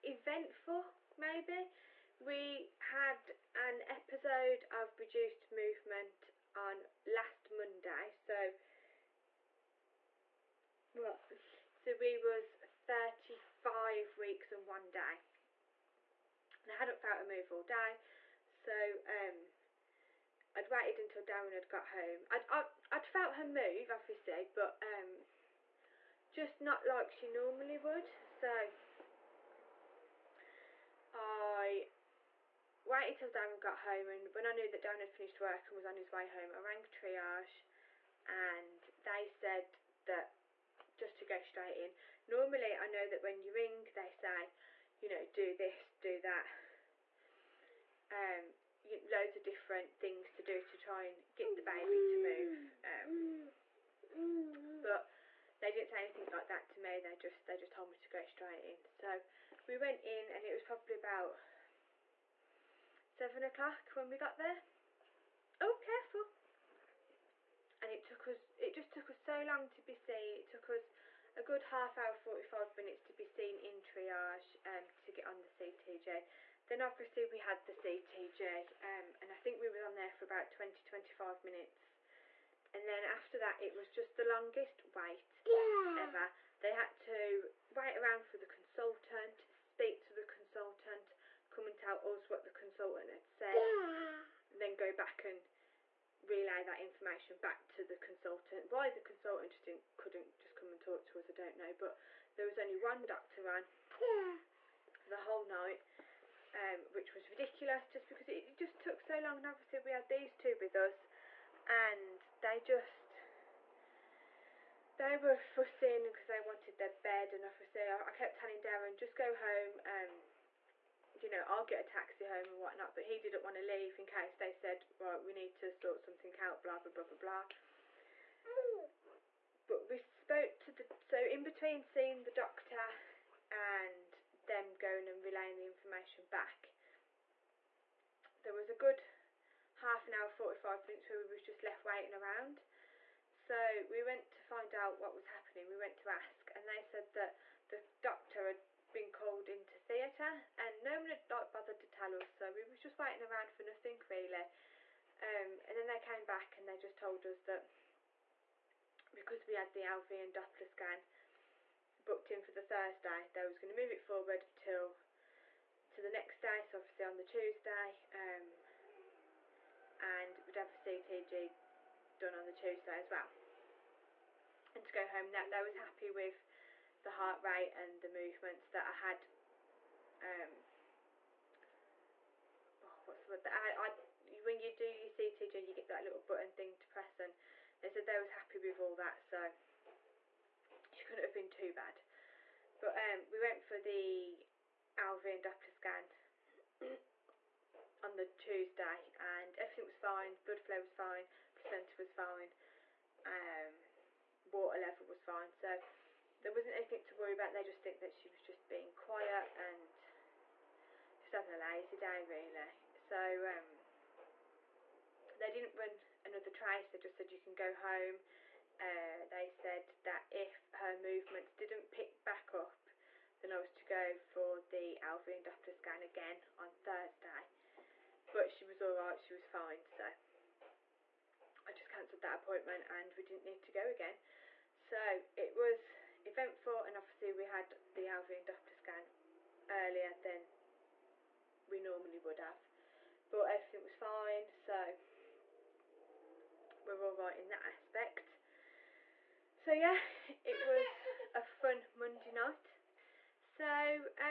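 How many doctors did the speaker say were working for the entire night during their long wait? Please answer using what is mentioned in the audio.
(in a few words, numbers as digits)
1.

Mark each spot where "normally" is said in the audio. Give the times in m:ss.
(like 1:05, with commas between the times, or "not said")
0:27, 0:42, 4:01.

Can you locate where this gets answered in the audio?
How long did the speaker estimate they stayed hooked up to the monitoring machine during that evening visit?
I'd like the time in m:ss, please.
1:20.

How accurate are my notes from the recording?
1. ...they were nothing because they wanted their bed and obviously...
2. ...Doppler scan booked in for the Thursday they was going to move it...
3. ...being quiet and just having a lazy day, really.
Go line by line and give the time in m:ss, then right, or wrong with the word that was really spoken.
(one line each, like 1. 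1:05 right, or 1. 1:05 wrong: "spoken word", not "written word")
1. 1:54 wrong: "fussing", not "nothing"
2. 2:40 right
3. 3:28 right.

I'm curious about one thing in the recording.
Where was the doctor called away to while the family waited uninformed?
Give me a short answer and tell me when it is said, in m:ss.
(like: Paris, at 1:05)
Theatre, at 2:29.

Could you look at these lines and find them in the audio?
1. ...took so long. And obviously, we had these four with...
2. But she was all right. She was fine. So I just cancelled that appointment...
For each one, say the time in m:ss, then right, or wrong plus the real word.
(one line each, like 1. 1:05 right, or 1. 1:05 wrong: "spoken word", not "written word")
1. 1:48 wrong: "two", not "four"
2. 3:48 right.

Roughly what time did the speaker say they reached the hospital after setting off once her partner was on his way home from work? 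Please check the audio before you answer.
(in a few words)
7 o'clock.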